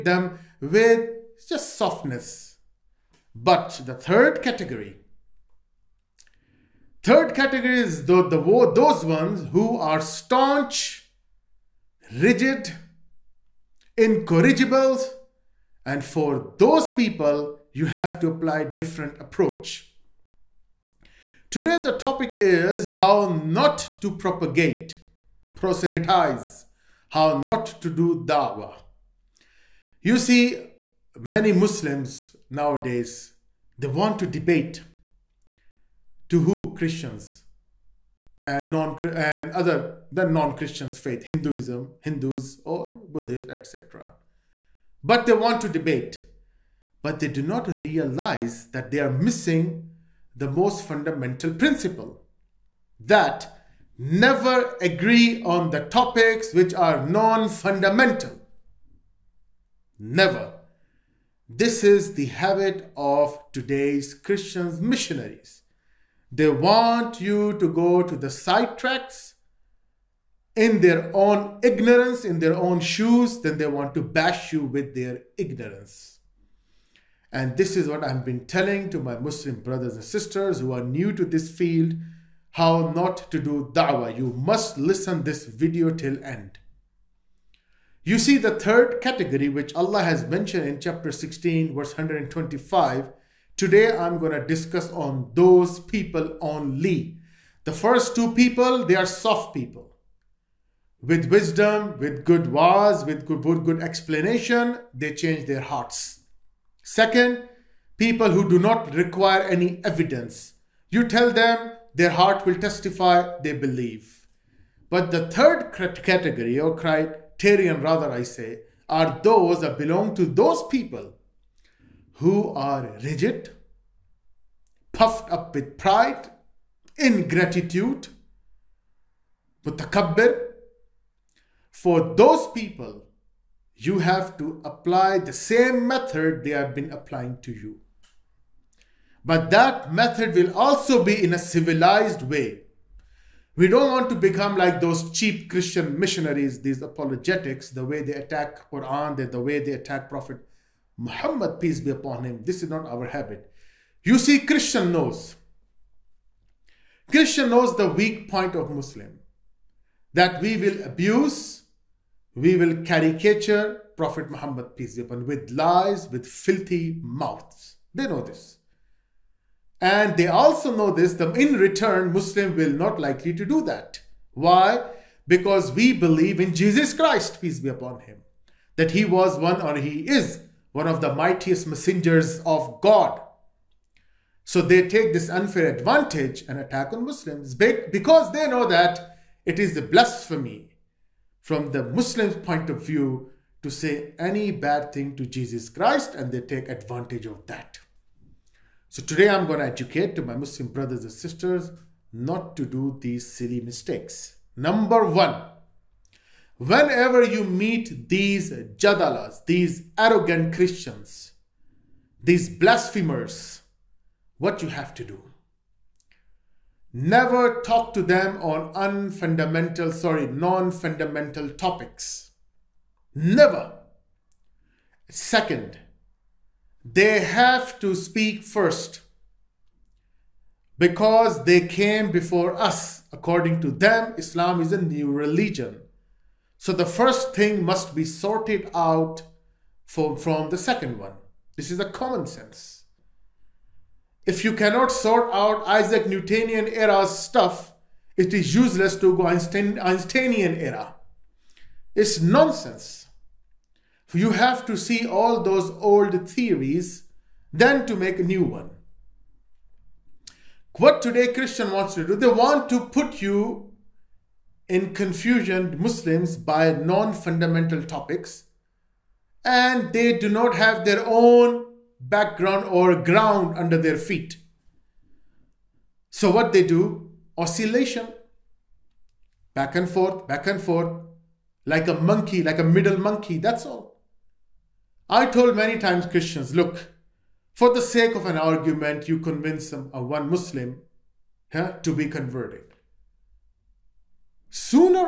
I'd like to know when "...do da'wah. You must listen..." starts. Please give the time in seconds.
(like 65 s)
83 s.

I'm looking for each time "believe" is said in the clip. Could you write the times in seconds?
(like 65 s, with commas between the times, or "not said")
113 s, 175 s.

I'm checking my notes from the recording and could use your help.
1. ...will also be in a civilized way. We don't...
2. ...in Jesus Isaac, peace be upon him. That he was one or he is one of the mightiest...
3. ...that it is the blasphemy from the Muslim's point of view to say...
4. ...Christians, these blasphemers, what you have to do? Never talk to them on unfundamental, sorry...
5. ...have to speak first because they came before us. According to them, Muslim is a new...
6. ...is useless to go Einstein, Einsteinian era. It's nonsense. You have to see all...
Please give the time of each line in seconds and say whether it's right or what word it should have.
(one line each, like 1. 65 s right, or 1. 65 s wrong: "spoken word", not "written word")
1. 140 s right
2. 176 s wrong: "Christ", not "Isaac"
3. 188 s right
4. 210 s right
5. 227 s wrong: "Islam", not "Muslim"
6. 248 s right.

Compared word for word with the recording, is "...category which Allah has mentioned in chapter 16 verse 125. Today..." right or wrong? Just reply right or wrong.
right.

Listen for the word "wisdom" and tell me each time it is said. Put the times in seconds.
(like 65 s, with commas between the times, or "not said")
101 s.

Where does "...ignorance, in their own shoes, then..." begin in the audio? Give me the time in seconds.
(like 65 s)
71 s.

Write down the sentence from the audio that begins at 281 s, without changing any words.
Like a monkey, like a middle monkey, that's all.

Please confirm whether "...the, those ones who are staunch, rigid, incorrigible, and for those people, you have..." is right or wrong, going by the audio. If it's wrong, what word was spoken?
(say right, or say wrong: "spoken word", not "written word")
right.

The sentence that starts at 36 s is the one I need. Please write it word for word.
Christians and, non, and other than non-Christians faith, Hinduism, Hindus or Buddhists, etc but they want to debate.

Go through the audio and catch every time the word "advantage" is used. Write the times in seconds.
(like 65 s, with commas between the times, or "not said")
185 s, 196 s.